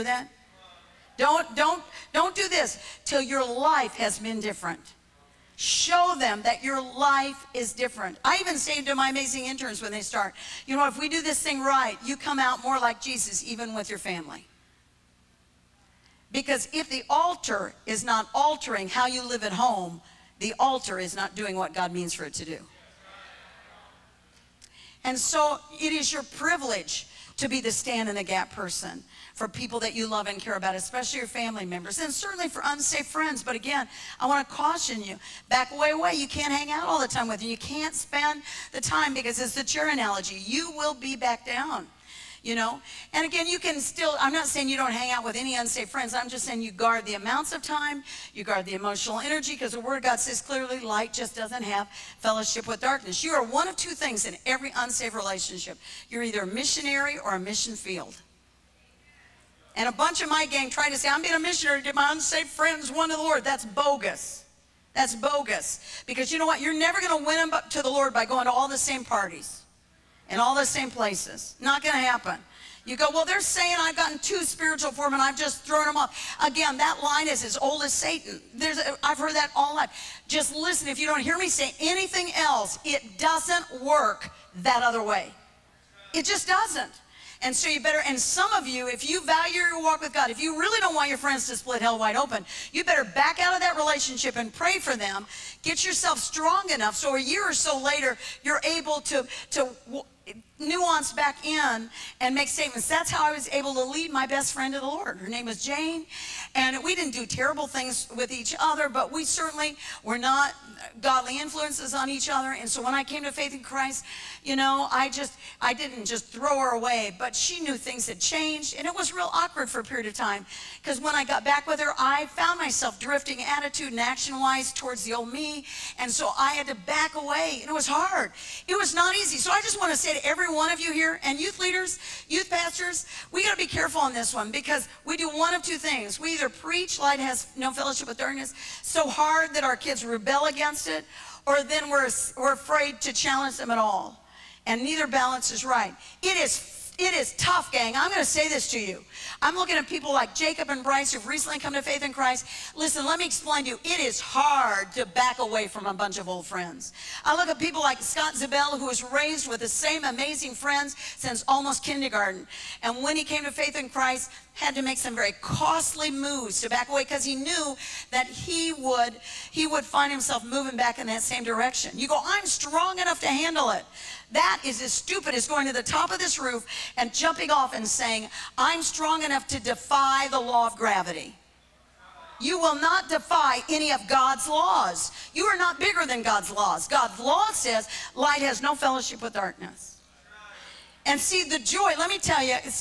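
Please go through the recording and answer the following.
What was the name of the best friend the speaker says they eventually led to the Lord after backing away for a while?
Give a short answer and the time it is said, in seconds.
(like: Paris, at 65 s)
Jane, at 105 s.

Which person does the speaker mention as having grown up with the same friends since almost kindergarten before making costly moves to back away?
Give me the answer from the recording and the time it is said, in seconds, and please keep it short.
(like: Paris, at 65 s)
Scott Zabel, at 158 s.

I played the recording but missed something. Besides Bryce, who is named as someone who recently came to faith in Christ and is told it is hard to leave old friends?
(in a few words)
Jacob.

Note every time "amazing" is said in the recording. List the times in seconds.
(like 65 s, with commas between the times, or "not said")
9 s, 160 s.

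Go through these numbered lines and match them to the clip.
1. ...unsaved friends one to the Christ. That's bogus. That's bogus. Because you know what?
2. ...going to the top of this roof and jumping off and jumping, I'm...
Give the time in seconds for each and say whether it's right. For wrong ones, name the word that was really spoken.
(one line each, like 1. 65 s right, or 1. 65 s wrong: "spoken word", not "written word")
1. 62 s wrong: "Lord", not "Christ"
2. 175 s wrong: "saying", not "jumping".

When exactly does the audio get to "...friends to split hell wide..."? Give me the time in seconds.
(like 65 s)
91 s.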